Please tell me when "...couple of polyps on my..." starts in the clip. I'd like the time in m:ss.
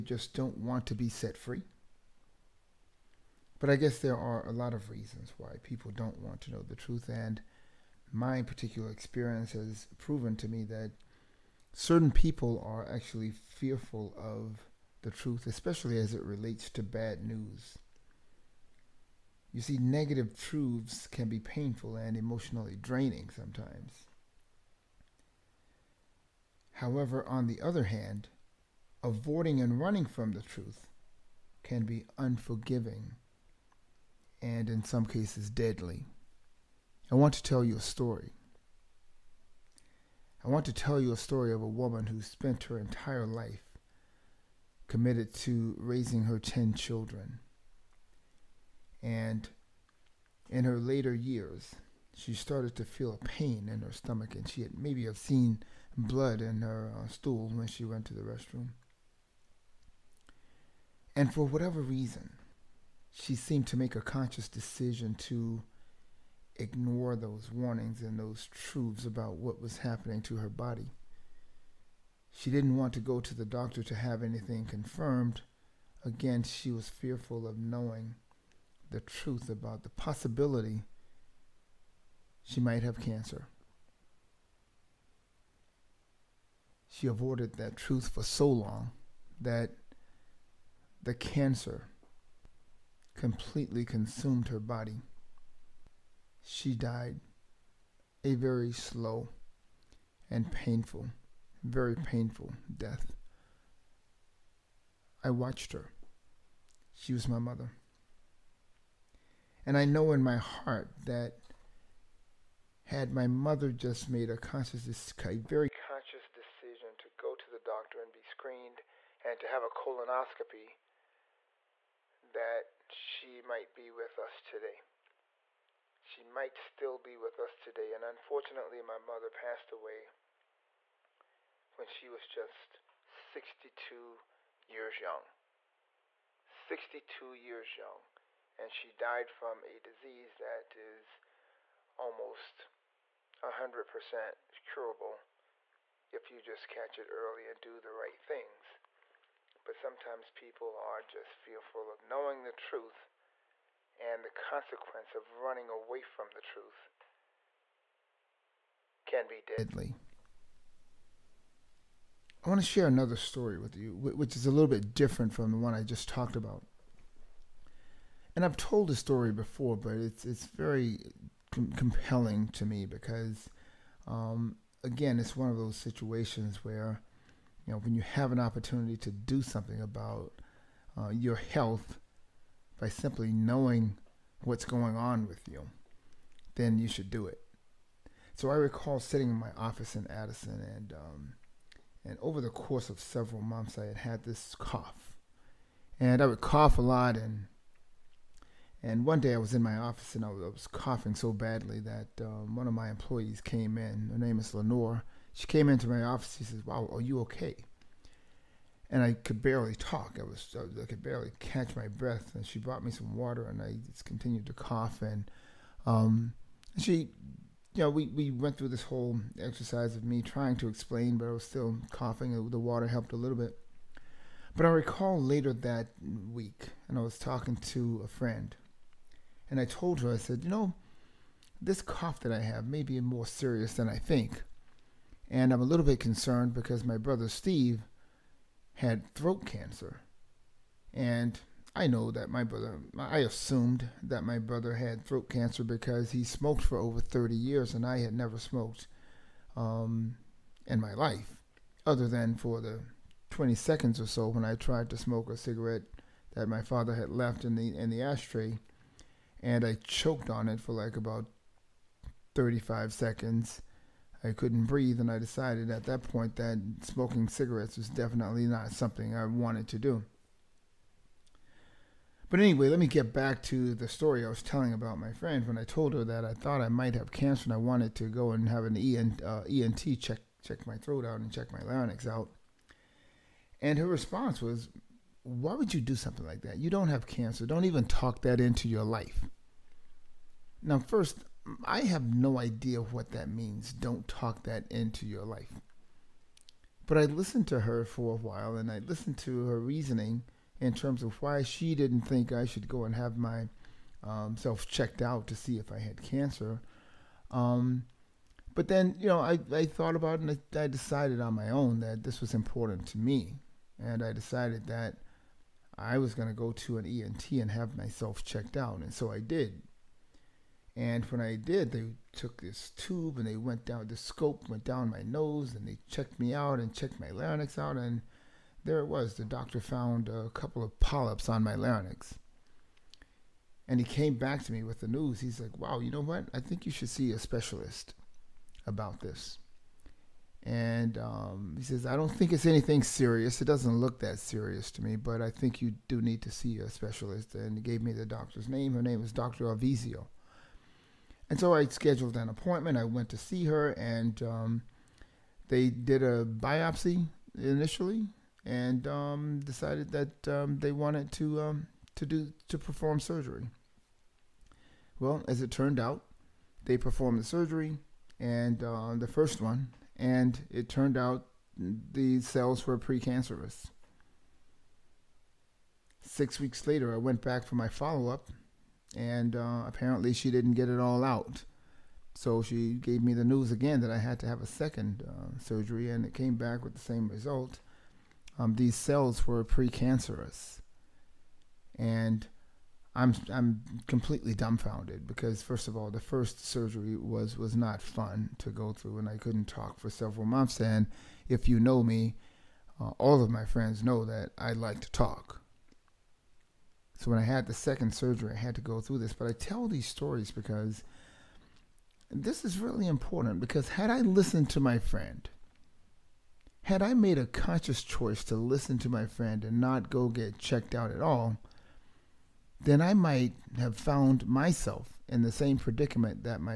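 5:30.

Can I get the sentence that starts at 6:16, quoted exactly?
Six weeks later, I went back for my follow up, and uh, apparently she didn't get it all out.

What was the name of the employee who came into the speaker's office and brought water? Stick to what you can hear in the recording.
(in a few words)
Lenore.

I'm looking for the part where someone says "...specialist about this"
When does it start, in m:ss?
5:37.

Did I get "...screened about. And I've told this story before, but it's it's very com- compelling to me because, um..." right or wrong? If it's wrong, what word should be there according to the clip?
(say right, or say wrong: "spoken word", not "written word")
wrong: "talked", not "screened".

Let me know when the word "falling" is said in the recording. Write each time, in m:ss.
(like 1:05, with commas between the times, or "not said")
not said.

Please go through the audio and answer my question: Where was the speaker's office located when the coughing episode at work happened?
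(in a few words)
Addison.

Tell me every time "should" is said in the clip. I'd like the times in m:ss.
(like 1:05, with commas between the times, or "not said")
3:06, 5:02, 5:36.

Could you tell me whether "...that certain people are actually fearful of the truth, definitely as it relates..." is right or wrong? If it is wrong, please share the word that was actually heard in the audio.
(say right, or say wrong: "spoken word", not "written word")
wrong: "especially", not "definitely".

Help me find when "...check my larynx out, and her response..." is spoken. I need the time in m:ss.
4:41.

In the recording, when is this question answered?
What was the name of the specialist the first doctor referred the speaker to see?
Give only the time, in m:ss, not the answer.
5:49.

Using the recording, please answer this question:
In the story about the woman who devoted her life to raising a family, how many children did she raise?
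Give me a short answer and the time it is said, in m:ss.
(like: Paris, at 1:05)
10, at 0:46.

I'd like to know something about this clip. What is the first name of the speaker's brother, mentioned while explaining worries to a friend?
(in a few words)
Steve.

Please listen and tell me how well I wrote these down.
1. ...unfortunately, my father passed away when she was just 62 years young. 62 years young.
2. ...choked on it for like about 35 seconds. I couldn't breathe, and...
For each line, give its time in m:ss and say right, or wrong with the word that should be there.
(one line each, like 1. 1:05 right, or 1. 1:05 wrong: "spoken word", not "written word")
1. 2:08 wrong: "mother", not "father"
2. 4:19 right.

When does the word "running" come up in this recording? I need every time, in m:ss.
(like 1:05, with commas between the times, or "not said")
0:29, 2:35.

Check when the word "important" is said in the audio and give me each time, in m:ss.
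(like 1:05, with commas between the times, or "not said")
5:12, 6:52.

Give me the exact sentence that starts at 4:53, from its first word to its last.
Don't talk that into your life.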